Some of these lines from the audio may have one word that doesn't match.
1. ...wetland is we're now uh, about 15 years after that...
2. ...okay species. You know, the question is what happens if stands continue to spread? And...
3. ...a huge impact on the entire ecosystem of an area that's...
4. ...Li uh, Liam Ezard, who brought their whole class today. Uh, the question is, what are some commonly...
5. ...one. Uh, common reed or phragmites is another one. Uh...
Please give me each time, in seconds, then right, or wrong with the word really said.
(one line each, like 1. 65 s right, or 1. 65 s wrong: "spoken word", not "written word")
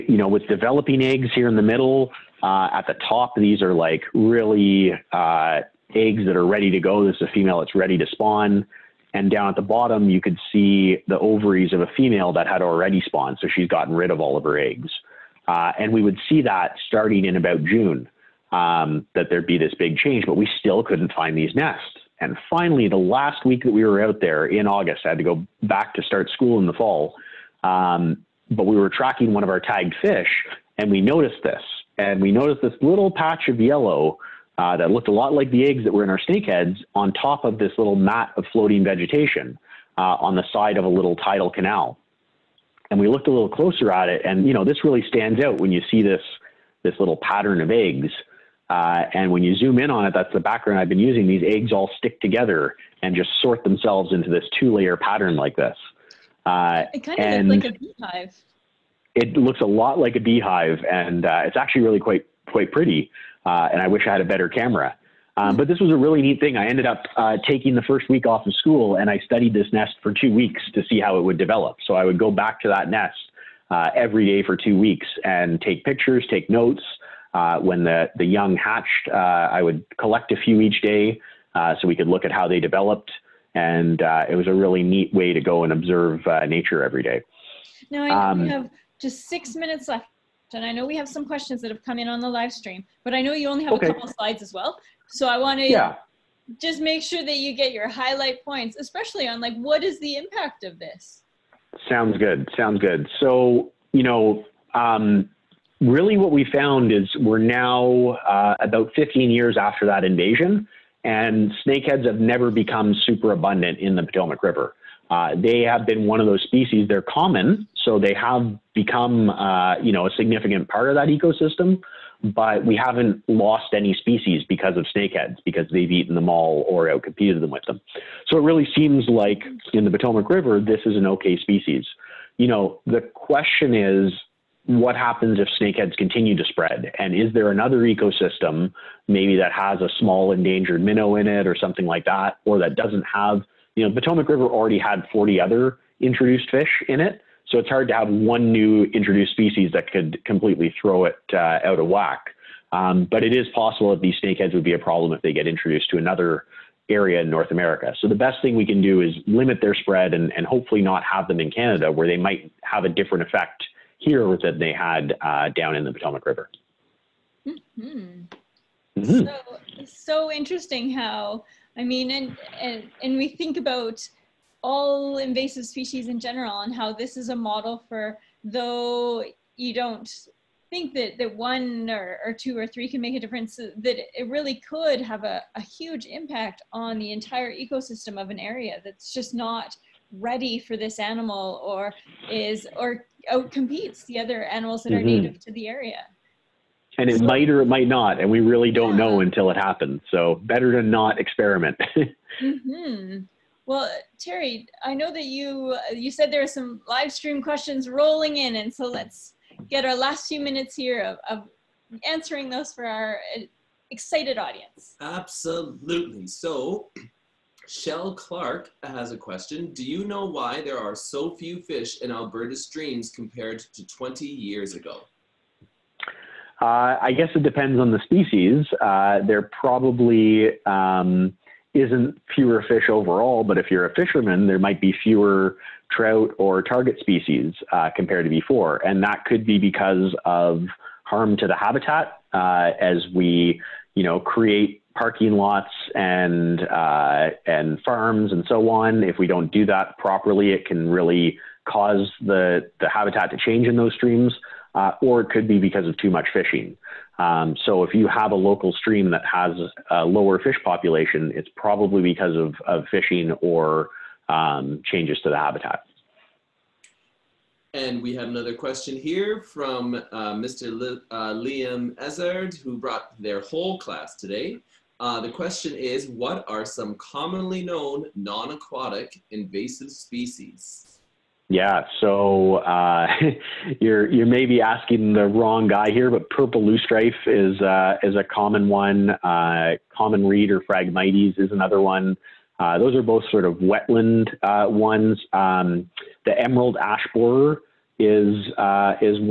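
1. 106 s wrong: "found", not "wetland"
2. 131 s wrong: "snakeheads", not "stands"
3. 185 s right
4. 270 s right
5. 288 s right.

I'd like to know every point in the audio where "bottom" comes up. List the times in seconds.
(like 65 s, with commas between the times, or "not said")
9 s.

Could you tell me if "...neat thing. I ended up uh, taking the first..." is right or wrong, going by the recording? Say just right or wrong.
right.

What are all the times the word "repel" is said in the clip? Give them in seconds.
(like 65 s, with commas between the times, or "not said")
not said.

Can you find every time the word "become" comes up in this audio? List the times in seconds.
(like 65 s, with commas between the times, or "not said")
112 s, 118 s.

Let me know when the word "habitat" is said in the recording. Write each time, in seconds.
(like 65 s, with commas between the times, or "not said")
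241 s, 252 s, 265 s.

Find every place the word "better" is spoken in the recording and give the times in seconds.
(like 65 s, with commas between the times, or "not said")
64 s, 200 s.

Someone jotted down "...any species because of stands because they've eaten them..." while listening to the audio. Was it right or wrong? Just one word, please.
wrong.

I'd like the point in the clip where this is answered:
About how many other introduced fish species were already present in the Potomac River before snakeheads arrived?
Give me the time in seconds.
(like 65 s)
145 s.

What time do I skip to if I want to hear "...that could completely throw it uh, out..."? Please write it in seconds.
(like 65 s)
149 s.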